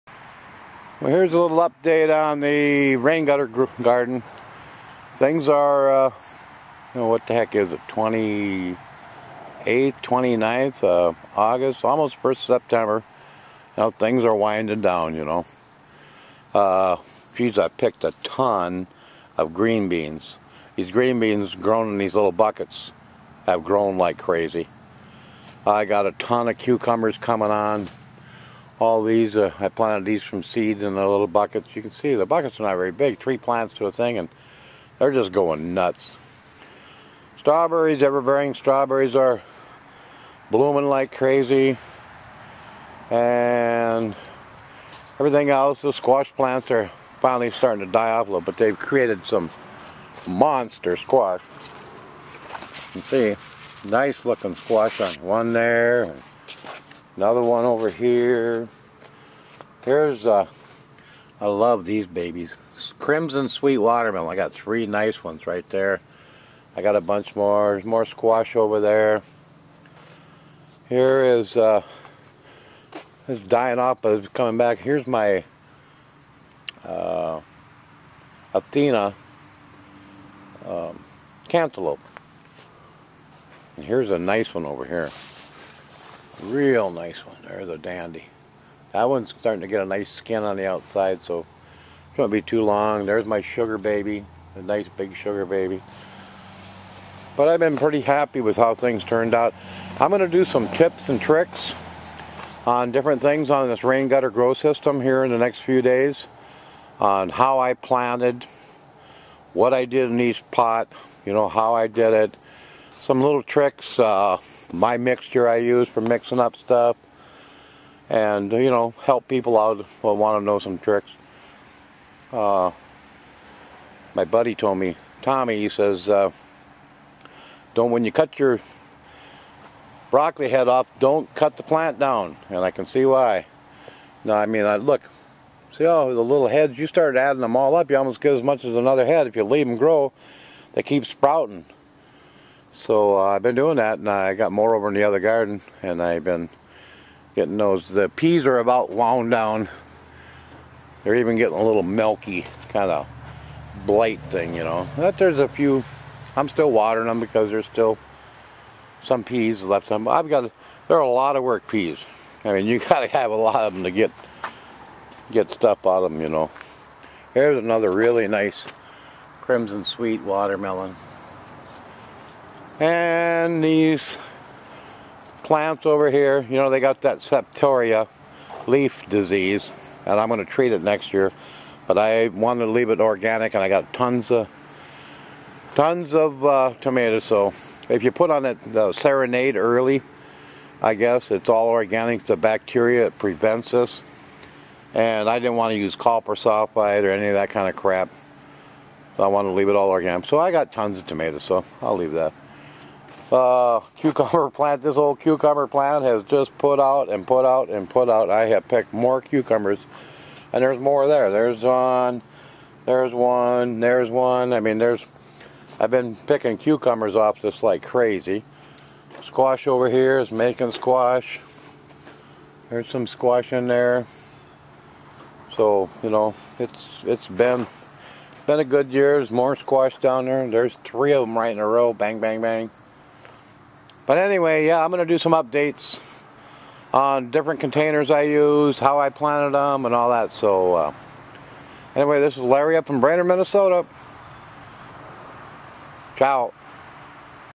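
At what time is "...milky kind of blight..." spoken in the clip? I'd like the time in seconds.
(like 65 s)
151 s.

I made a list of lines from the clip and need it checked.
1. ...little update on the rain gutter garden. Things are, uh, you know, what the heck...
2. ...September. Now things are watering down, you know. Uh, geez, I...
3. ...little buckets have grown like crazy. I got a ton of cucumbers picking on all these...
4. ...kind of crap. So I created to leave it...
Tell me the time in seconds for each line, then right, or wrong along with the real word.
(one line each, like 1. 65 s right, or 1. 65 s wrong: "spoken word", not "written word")
1. 1 s right
2. 12 s wrong: "winding", not "watering"
3. 22 s wrong: "coming", not "picking"
4. 197 s wrong: "wanted", not "created".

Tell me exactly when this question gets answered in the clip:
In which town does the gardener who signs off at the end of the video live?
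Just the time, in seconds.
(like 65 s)
242 s.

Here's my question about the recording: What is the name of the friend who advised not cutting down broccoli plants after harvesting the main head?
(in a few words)
Tommy.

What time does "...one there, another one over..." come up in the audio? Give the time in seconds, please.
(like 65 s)
55 s.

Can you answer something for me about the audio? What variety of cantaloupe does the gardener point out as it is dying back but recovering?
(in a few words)
Athena.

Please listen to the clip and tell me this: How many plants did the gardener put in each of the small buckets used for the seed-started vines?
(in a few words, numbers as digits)
3.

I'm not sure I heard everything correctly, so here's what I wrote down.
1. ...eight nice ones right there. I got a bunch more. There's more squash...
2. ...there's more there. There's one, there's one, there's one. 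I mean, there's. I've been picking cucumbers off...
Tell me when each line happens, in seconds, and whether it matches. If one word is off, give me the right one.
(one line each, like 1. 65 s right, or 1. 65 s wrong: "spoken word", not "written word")
1. 64 s wrong: "three", not "eight"
2. 210 s right.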